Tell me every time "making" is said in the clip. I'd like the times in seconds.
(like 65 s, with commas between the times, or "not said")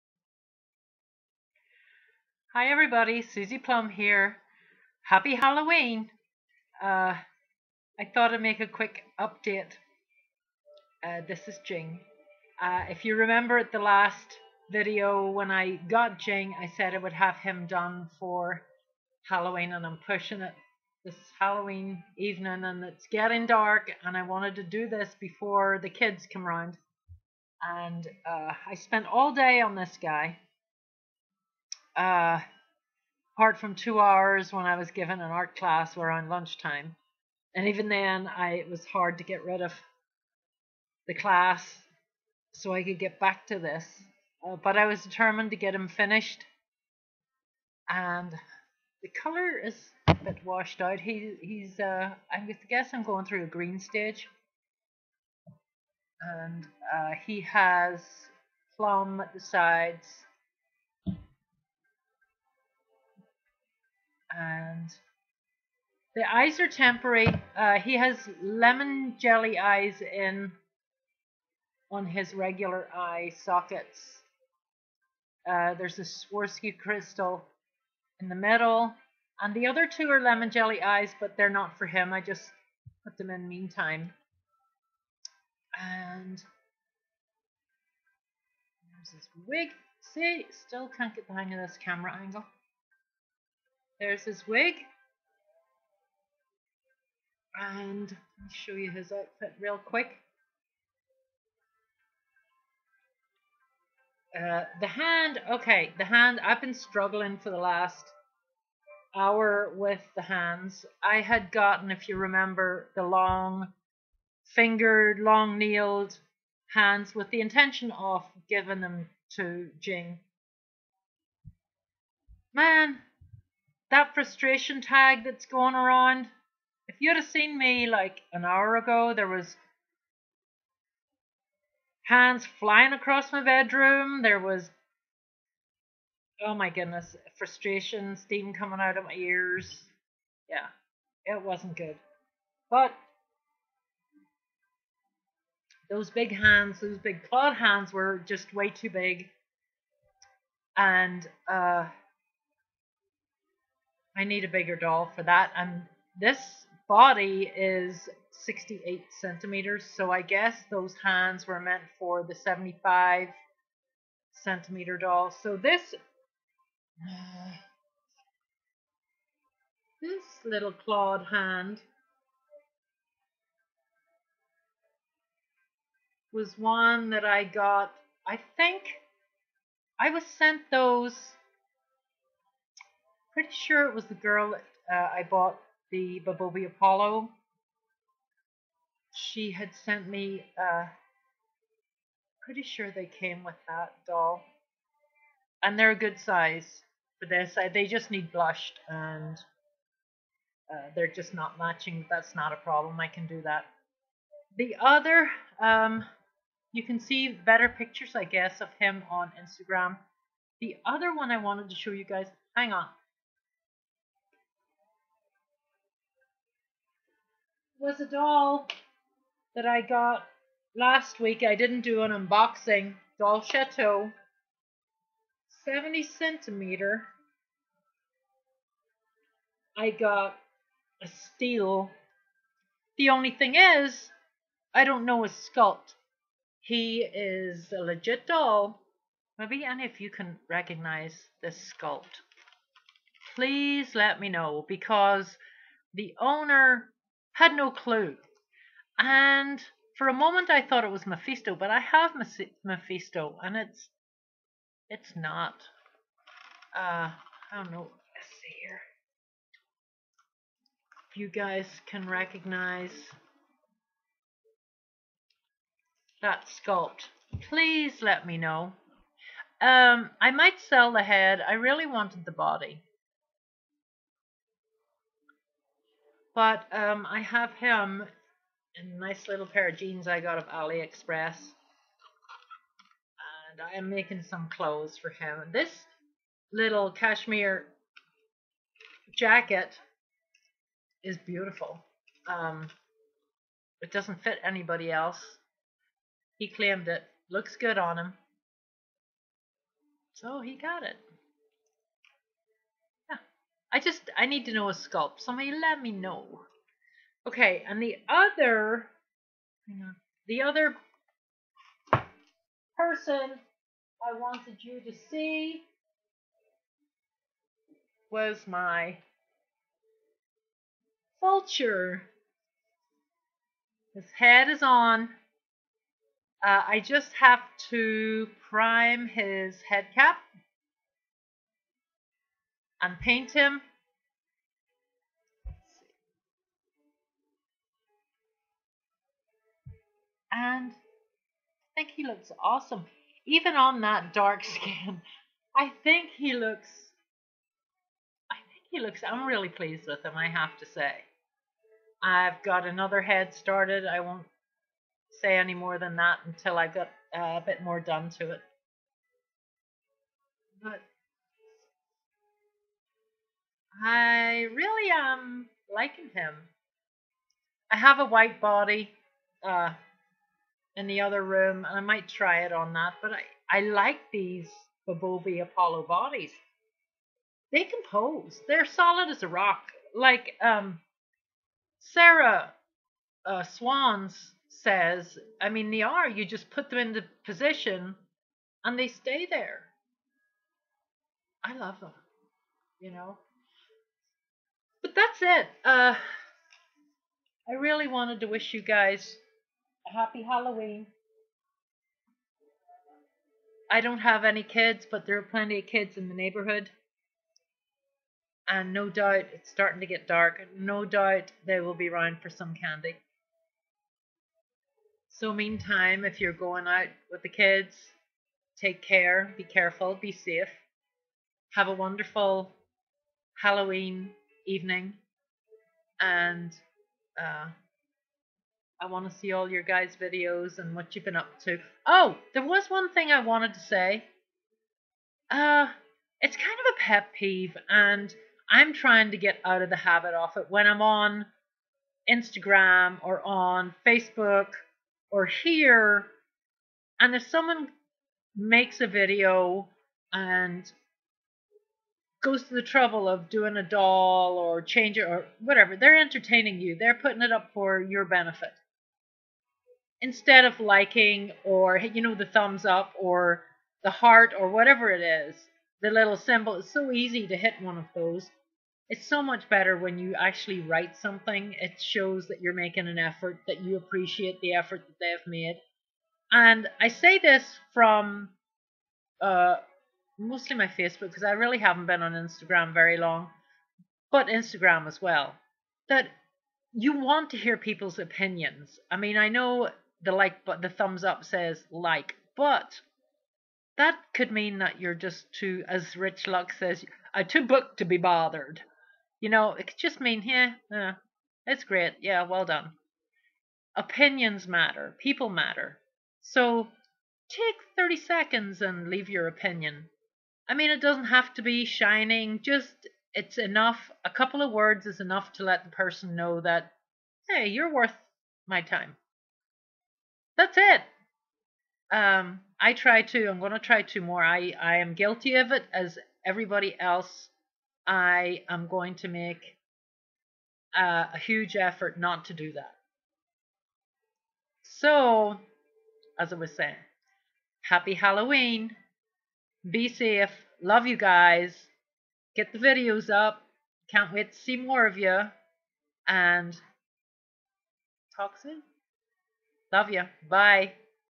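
283 s, 472 s.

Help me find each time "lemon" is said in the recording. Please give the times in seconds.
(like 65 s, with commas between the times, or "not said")
68 s, 80 s.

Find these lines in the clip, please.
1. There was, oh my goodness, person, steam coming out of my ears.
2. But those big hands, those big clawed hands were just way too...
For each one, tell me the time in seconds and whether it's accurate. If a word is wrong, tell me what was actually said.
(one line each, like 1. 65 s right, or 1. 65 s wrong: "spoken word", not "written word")
1. 134 s wrong: "frustration", not "person"
2. 142 s right.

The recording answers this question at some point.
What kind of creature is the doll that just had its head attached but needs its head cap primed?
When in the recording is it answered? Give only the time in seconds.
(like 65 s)
321 s.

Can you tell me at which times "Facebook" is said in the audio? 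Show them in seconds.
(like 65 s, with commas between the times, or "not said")
443 s, 480 s.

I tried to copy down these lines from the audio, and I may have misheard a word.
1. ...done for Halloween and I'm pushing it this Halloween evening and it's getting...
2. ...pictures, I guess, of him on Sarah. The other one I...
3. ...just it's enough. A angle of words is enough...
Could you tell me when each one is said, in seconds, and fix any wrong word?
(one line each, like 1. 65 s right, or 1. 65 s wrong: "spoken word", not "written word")
1. 17 s right
2. 207 s wrong: "Instagram", not "Sarah"
3. 512 s wrong: "couple", not "angle".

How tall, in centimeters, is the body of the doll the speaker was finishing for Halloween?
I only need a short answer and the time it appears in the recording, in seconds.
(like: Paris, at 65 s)
68, at 158 s.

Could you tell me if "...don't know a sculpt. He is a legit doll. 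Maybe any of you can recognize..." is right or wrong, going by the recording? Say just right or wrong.
right.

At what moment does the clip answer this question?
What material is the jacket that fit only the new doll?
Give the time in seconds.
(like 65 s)
286 s.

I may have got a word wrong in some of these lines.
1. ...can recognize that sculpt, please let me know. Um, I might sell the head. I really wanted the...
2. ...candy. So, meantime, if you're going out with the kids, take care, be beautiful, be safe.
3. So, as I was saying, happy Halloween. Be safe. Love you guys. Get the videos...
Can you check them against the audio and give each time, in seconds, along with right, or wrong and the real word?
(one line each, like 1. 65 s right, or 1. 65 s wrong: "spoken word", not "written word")
1. 261 s right
2. 412 s wrong: "careful", not "beautiful"
3. 534 s right.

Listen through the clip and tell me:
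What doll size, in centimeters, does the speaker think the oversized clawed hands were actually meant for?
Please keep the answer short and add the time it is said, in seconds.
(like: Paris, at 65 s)
75, at 162 s.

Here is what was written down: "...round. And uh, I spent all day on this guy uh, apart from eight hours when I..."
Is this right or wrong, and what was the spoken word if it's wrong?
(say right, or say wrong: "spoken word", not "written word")
wrong: "two", not "eight".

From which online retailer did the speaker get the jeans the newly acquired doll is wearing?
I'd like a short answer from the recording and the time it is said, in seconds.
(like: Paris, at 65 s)
AliExpress, at 280 s.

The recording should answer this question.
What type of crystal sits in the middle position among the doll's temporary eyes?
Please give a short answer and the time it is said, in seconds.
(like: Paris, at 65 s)
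Swarovski, at 76 s.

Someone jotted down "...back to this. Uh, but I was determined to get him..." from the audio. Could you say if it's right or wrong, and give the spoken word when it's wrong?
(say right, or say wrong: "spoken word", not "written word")
right.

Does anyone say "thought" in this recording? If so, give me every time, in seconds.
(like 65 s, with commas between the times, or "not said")
8 s, 250 s.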